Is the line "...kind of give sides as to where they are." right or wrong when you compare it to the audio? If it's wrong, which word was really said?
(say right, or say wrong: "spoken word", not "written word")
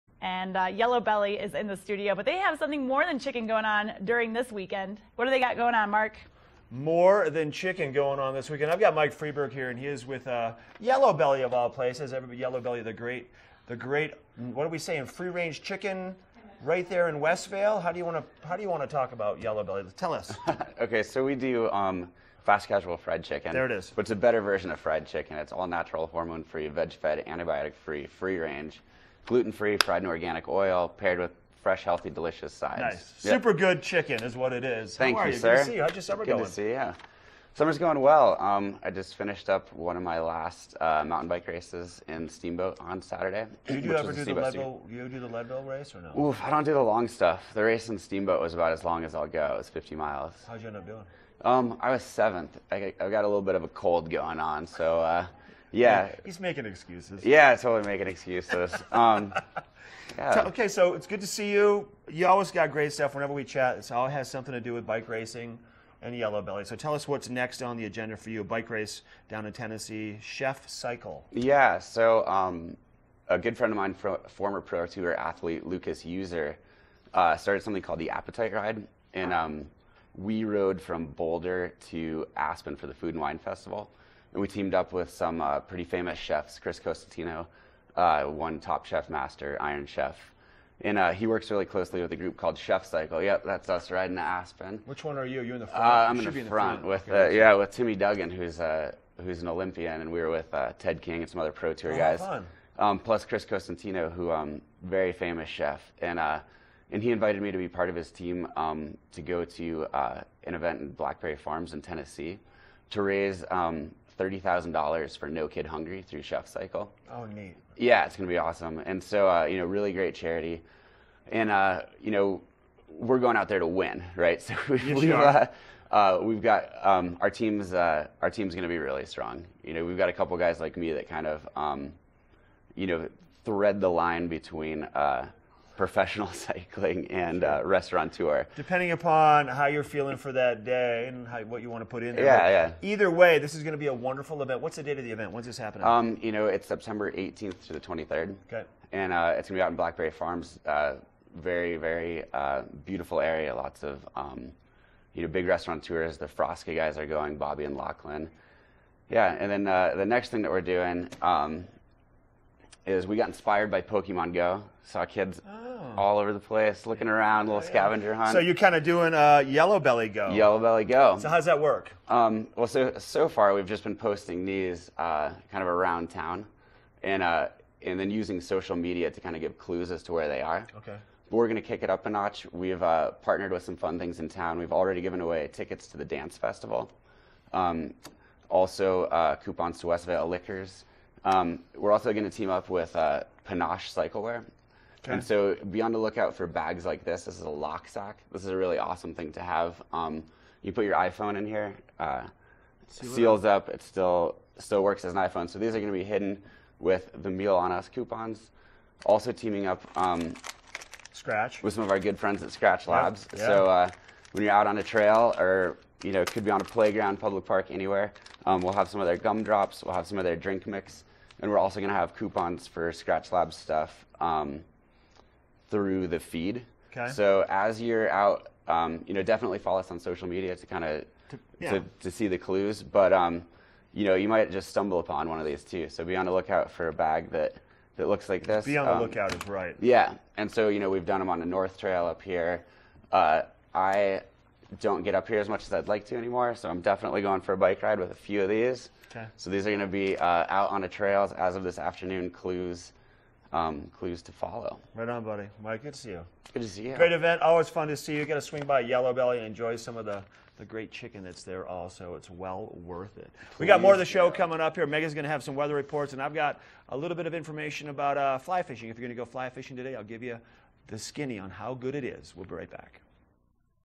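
wrong: "clues", not "sides".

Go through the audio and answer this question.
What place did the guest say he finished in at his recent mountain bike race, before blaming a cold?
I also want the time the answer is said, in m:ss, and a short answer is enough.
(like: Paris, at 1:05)
7th, at 0:52.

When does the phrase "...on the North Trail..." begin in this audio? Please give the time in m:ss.
4:01.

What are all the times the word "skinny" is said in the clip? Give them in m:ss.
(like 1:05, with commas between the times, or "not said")
4:30.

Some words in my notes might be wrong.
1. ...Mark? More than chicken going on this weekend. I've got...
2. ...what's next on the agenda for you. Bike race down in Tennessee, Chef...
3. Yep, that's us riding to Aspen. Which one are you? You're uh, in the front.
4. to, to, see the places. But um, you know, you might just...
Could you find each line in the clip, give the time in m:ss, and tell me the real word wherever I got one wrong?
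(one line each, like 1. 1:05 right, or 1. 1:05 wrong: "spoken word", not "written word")
1. 0:05 right
2. 1:07 right
3. 1:33 right
4. 3:51 wrong: "clues", not "places".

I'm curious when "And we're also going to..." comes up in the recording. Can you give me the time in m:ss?
3:41.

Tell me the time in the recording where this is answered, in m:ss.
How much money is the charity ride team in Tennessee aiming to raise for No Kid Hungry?
1:54.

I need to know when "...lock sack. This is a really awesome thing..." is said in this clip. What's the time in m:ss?
3:17.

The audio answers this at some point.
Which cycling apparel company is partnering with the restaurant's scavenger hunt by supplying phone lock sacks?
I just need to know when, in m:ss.
3:13.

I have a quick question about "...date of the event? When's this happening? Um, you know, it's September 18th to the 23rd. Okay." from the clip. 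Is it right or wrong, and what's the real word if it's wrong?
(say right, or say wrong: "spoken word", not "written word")
right.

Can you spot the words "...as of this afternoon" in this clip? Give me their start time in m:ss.
4:11.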